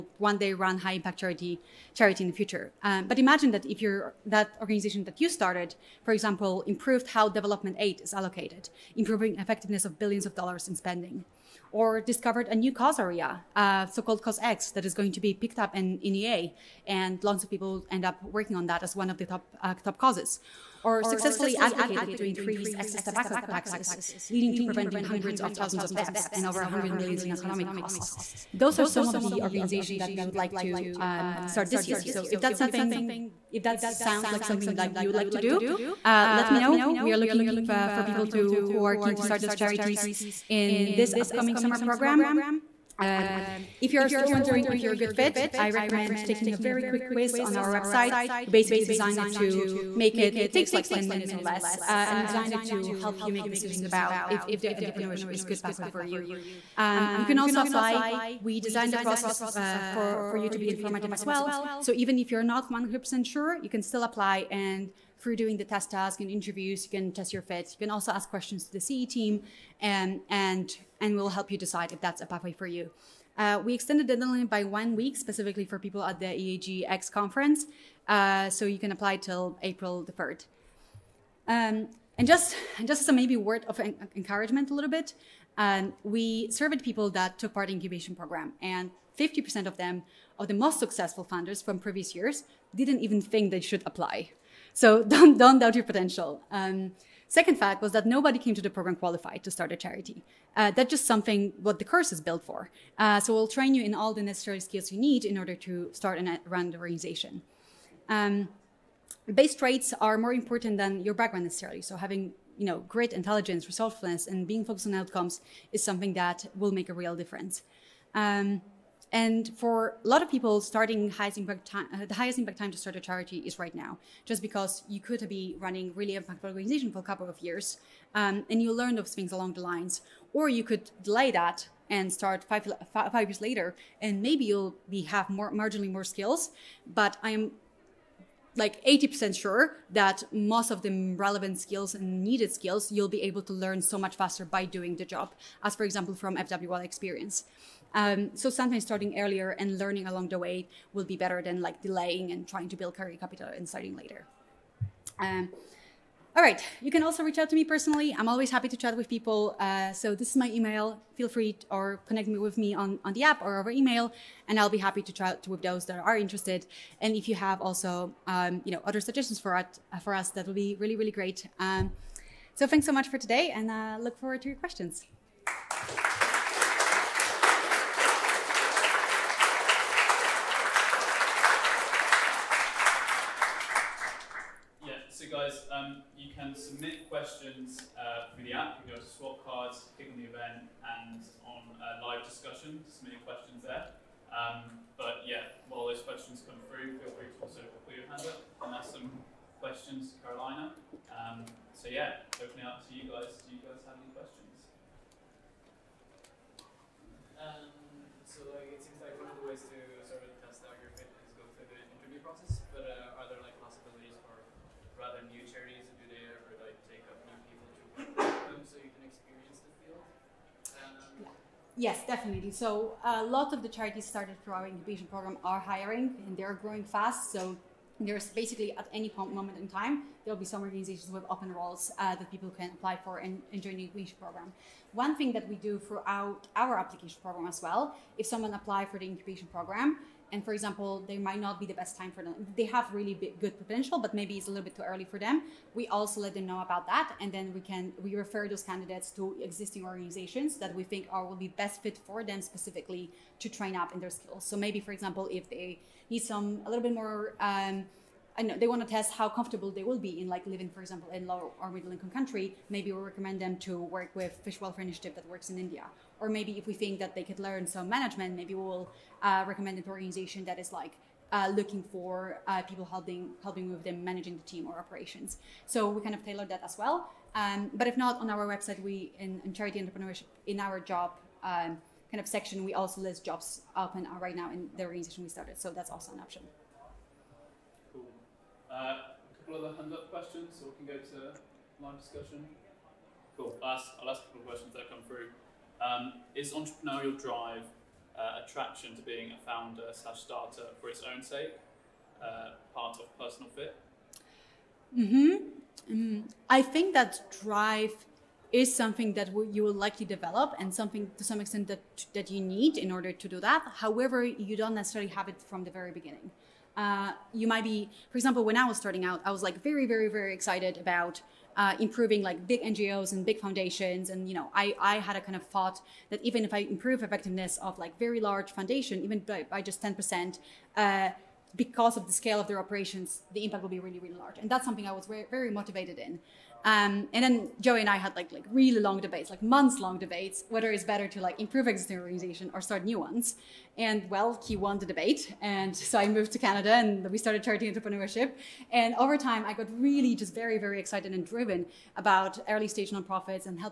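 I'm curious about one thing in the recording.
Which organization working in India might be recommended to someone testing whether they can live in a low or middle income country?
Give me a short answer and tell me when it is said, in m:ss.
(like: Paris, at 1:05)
Fish Welfare Initiative, at 4:24.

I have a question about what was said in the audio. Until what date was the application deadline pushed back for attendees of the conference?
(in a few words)
April 3.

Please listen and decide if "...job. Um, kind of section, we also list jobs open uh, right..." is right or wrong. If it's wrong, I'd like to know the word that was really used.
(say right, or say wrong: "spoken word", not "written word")
right.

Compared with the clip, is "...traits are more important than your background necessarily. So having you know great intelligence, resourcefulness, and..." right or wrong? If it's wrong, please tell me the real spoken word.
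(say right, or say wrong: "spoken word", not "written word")
right.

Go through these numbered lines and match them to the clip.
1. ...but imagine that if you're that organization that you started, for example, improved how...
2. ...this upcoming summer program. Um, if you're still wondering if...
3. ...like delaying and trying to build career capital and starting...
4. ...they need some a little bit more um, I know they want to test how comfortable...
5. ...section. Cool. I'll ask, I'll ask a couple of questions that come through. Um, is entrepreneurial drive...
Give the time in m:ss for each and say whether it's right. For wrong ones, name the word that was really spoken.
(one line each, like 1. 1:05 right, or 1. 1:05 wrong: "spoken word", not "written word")
1. 0:03 right
2. 0:40 right
3. 2:31 right
4. 4:15 right
5. 4:51 wrong: "discussion", not "section".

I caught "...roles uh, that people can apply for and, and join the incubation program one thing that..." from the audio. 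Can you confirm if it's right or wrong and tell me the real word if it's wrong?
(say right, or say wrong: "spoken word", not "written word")
right.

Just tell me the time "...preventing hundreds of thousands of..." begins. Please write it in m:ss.
0:24.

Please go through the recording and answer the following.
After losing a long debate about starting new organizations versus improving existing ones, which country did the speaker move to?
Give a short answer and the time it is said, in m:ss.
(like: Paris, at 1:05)
Canada, at 5:46.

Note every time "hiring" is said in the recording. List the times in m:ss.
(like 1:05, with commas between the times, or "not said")
3:45.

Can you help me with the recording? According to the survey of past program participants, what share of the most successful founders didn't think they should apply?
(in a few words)
50%.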